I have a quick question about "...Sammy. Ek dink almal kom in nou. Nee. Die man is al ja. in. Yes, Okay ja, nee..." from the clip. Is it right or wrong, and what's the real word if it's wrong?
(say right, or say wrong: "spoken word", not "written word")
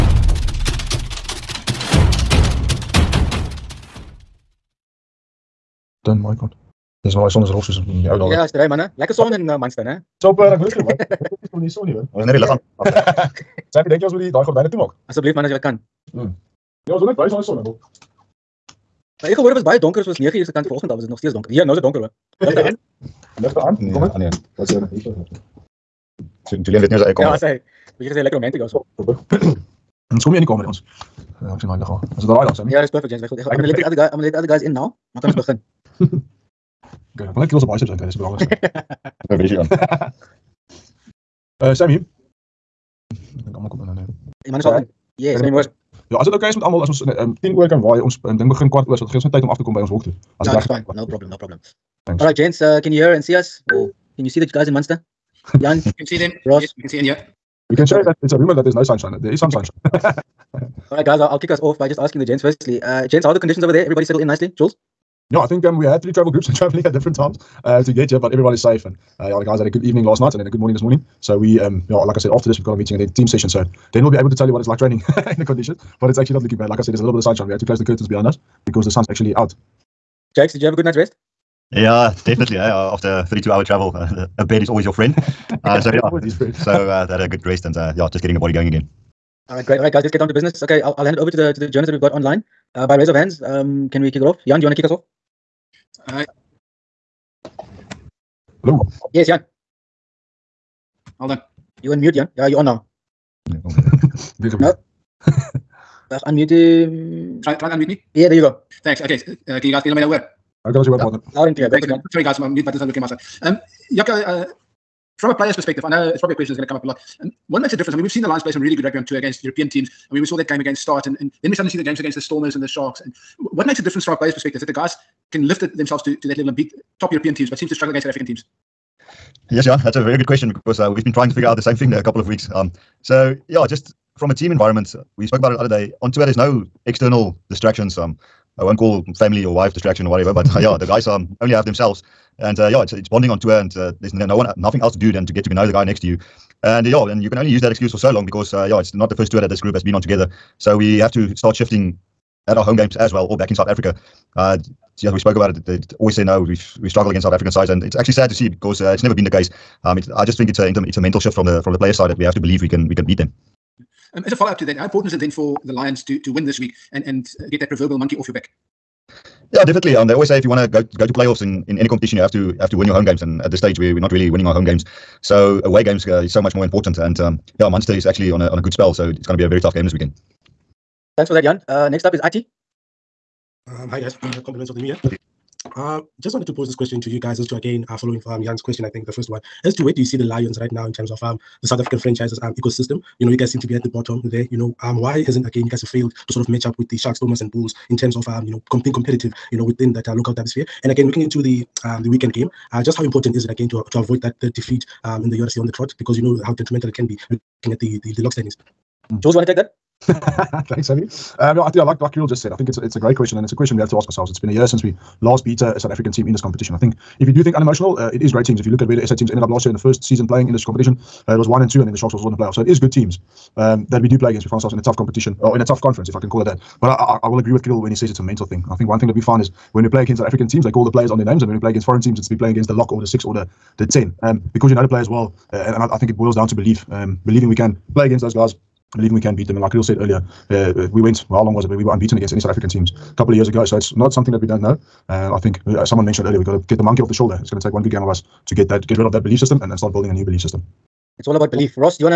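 wrong: "Sammy", not "Okay".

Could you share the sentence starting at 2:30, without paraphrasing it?
So we have to start shifting at our home games as well, or back in South Africa.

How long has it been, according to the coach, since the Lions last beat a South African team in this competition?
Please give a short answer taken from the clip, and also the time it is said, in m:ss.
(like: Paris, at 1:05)
A year, at 3:34.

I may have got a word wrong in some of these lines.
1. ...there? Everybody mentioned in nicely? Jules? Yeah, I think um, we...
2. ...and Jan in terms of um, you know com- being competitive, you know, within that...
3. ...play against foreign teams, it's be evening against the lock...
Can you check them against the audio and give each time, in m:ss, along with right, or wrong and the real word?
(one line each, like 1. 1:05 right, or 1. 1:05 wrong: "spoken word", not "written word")
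1. 1:03 wrong: "settled", not "mentioned"
2. 3:17 wrong: "Bulls", not "Jan"
3. 3:51 wrong: "playing", not "evening".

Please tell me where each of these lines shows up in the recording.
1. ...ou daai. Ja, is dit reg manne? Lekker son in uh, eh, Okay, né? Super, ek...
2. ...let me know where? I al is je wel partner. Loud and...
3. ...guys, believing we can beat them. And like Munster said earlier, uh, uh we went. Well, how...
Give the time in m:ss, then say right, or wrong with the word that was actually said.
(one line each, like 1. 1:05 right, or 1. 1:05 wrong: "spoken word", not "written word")
1. 0:08 wrong: "Manchester", not "Okay"
2. 1:49 right
3. 3:58 wrong: "Kriel", not "Munster".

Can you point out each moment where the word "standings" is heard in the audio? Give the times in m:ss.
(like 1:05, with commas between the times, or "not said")
3:28.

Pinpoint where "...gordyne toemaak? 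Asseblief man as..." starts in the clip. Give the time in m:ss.
0:14.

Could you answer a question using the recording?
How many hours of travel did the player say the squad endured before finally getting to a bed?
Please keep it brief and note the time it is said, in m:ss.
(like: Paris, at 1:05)
32 hours, at 1:23.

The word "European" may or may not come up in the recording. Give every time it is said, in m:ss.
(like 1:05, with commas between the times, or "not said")
1:59, 2:07.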